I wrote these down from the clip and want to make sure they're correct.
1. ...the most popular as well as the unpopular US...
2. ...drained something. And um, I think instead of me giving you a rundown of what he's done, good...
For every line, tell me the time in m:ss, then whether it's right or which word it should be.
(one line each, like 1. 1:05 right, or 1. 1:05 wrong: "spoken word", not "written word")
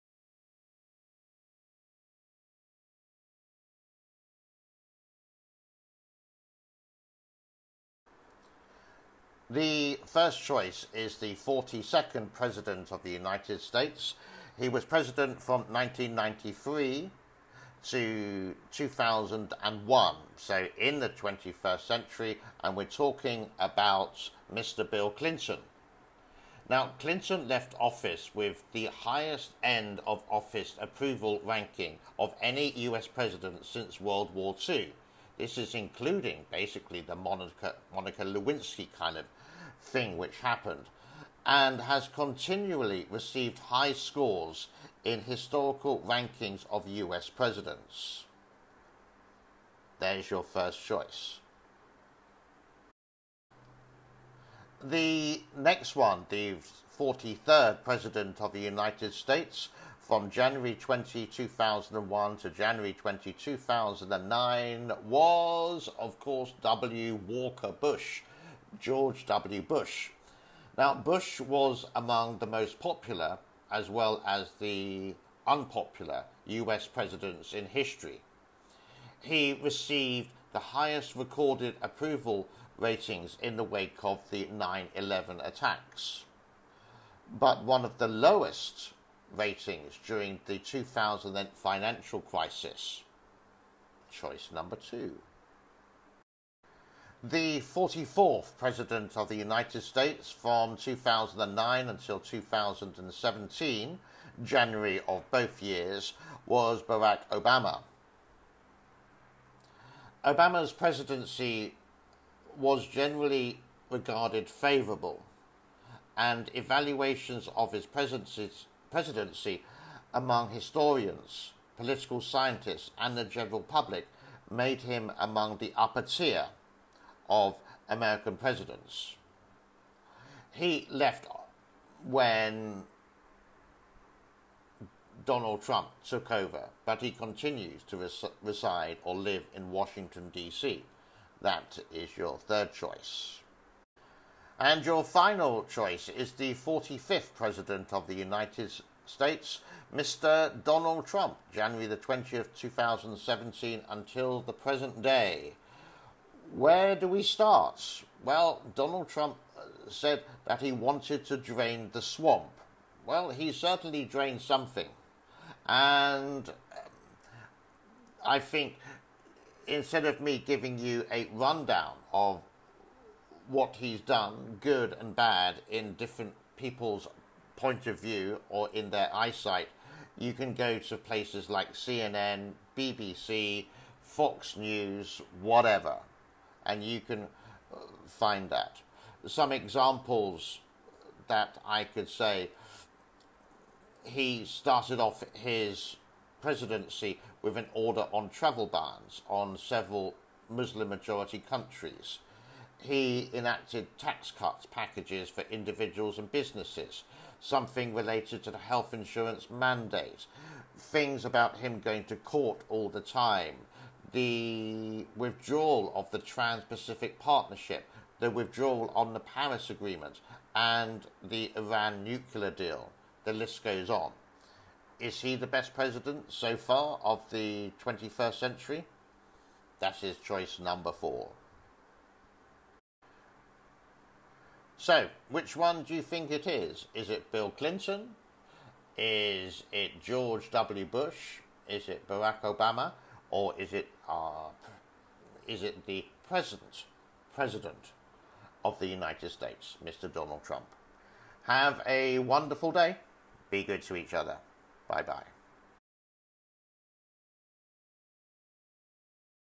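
1. 1:12 right
2. 2:44 right.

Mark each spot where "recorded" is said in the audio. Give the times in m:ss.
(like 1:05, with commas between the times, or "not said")
1:21.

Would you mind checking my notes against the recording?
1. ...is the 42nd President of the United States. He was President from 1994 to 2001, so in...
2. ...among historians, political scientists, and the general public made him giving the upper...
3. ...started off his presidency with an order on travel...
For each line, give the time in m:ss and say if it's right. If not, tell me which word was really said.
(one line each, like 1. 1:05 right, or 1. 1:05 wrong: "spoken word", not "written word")
1. 0:10 wrong: "1993", not "1994"
2. 2:00 wrong: "among", not "giving"
3. 3:14 right.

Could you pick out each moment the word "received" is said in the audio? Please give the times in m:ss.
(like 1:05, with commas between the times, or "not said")
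0:43, 1:19.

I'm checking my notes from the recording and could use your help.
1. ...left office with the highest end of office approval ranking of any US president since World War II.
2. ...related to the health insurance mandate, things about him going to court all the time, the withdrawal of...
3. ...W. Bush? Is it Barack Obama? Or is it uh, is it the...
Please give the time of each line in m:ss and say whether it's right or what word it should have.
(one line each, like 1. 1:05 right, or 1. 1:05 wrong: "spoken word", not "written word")
1. 0:27 right
2. 3:27 right
3. 4:00 right.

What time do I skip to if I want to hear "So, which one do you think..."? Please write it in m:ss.
3:54.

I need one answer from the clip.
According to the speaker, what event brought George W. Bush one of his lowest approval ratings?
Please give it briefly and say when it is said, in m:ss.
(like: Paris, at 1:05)
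2008 financial crisis, at 1:30.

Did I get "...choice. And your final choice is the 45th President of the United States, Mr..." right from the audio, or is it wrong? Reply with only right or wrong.
right.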